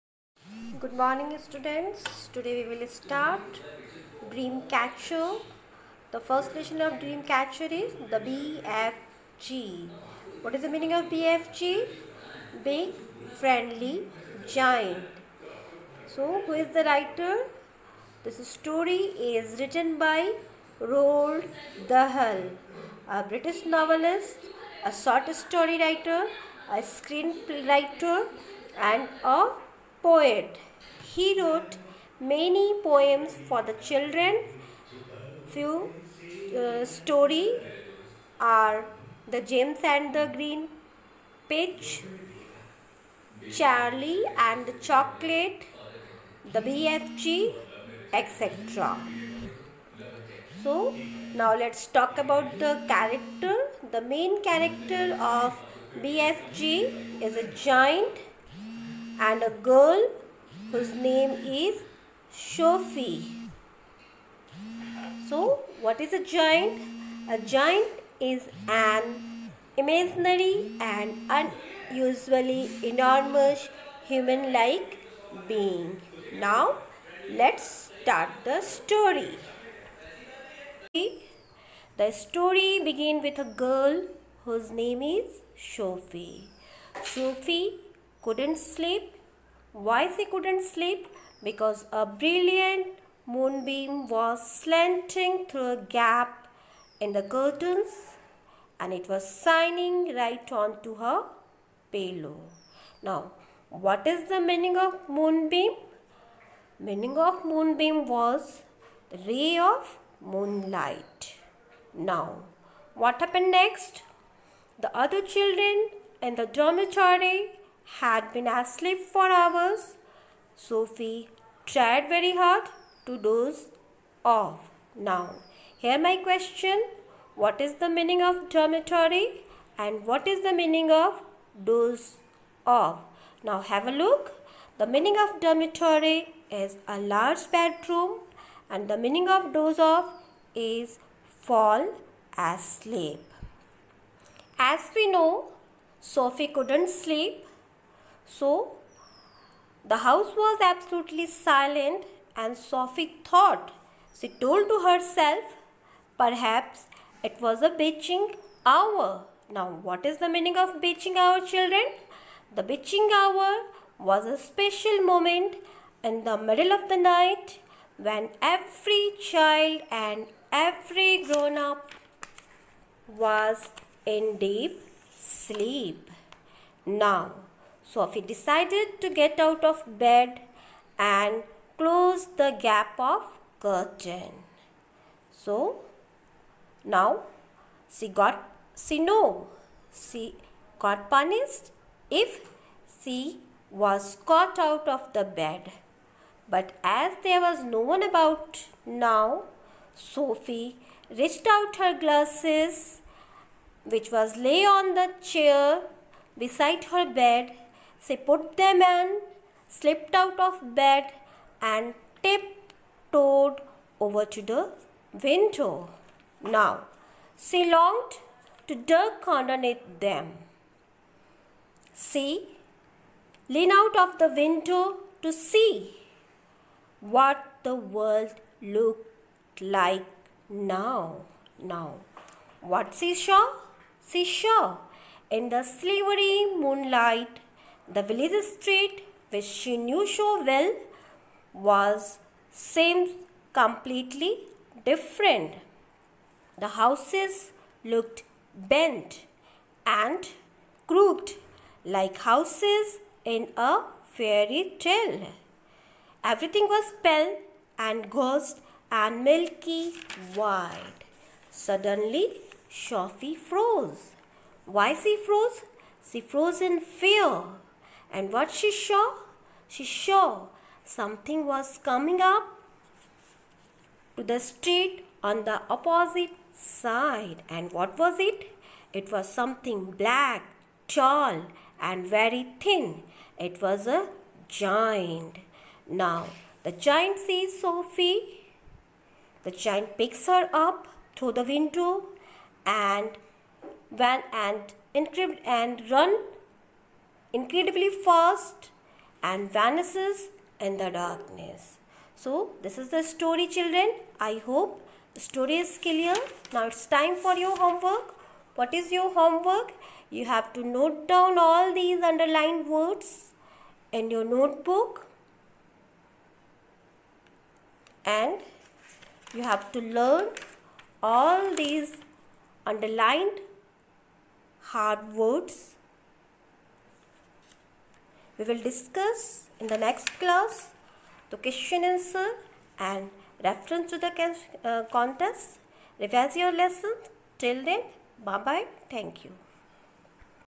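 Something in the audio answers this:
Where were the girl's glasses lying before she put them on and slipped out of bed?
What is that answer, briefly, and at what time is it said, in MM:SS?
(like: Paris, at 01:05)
On the chair, at 03:24.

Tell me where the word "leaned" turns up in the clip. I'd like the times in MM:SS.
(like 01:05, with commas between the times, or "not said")
03:43.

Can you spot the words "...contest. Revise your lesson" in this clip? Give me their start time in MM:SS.
05:34.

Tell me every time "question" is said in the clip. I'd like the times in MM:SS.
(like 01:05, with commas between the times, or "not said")
02:06, 05:31.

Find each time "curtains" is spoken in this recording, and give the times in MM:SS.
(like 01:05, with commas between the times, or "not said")
01:37, 03:03.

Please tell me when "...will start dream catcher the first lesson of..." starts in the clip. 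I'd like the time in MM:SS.
00:02.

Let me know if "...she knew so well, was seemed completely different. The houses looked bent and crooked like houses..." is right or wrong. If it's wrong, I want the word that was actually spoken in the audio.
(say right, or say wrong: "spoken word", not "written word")
right.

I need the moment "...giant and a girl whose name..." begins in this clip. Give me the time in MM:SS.
00:57.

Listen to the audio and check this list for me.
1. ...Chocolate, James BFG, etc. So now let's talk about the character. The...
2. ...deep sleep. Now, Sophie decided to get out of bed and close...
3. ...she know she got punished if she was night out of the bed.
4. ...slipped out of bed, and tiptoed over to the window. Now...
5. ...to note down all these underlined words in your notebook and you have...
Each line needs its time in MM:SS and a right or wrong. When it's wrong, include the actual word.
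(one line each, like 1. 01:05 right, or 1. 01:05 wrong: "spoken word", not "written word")
1. 00:44 wrong: "The", not "James"
2. 02:54 right
3. 03:08 wrong: "caught", not "night"
4. 03:29 right
5. 05:10 right.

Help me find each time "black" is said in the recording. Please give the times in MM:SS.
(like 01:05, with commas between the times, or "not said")
04:39.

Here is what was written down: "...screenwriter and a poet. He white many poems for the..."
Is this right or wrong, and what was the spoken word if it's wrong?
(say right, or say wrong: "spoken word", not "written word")
wrong: "wrote", not "white".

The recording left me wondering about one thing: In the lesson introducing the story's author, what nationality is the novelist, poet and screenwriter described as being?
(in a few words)
British.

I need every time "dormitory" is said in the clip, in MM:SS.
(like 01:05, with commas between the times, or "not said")
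01:56, 02:08, 02:15.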